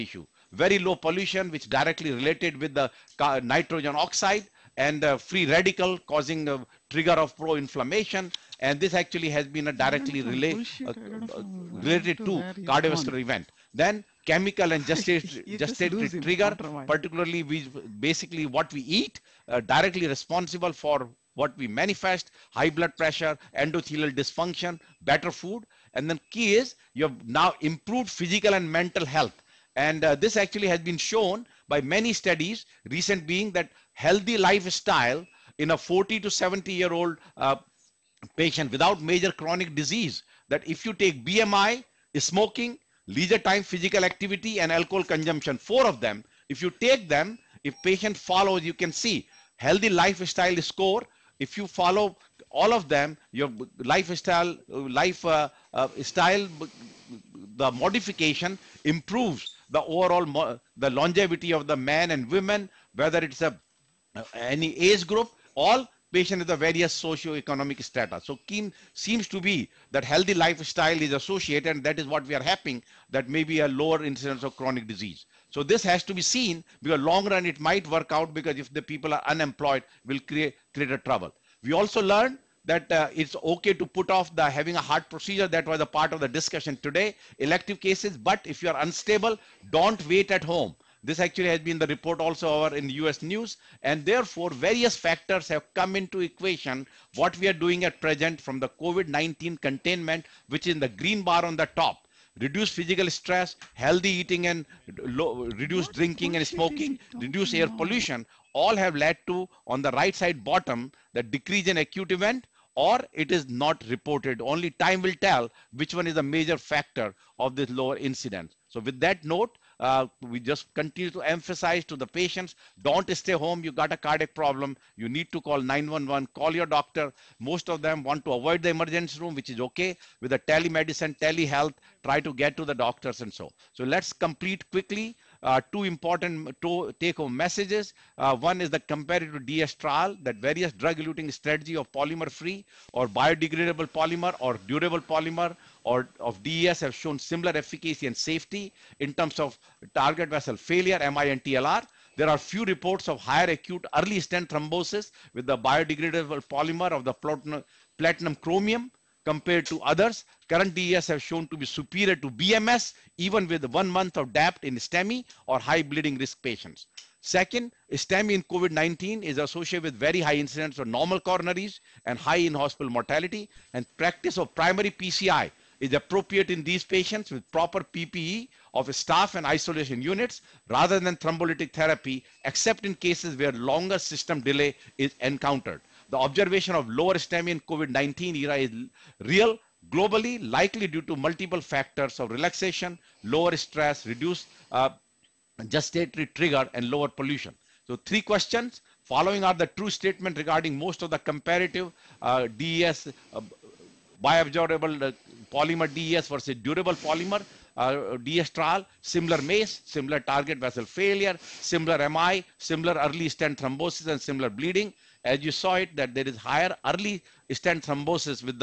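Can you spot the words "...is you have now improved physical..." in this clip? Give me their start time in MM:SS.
00:26.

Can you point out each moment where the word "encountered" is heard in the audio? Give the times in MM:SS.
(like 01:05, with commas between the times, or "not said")
03:05.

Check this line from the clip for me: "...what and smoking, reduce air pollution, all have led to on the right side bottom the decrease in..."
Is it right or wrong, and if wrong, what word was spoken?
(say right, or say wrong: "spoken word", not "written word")
right.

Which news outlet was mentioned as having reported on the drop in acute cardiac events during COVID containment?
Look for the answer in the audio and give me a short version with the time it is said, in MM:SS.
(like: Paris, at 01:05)
US News, at 01:32.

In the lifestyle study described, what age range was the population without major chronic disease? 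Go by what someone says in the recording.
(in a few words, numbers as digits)
40 to 70.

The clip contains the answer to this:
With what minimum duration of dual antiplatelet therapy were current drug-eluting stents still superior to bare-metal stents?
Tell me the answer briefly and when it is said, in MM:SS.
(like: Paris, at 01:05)
one month, at 02:43.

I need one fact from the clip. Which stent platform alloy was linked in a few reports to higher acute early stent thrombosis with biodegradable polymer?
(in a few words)
platinum chromium.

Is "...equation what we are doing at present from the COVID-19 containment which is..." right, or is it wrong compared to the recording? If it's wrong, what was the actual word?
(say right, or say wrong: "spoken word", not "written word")
right.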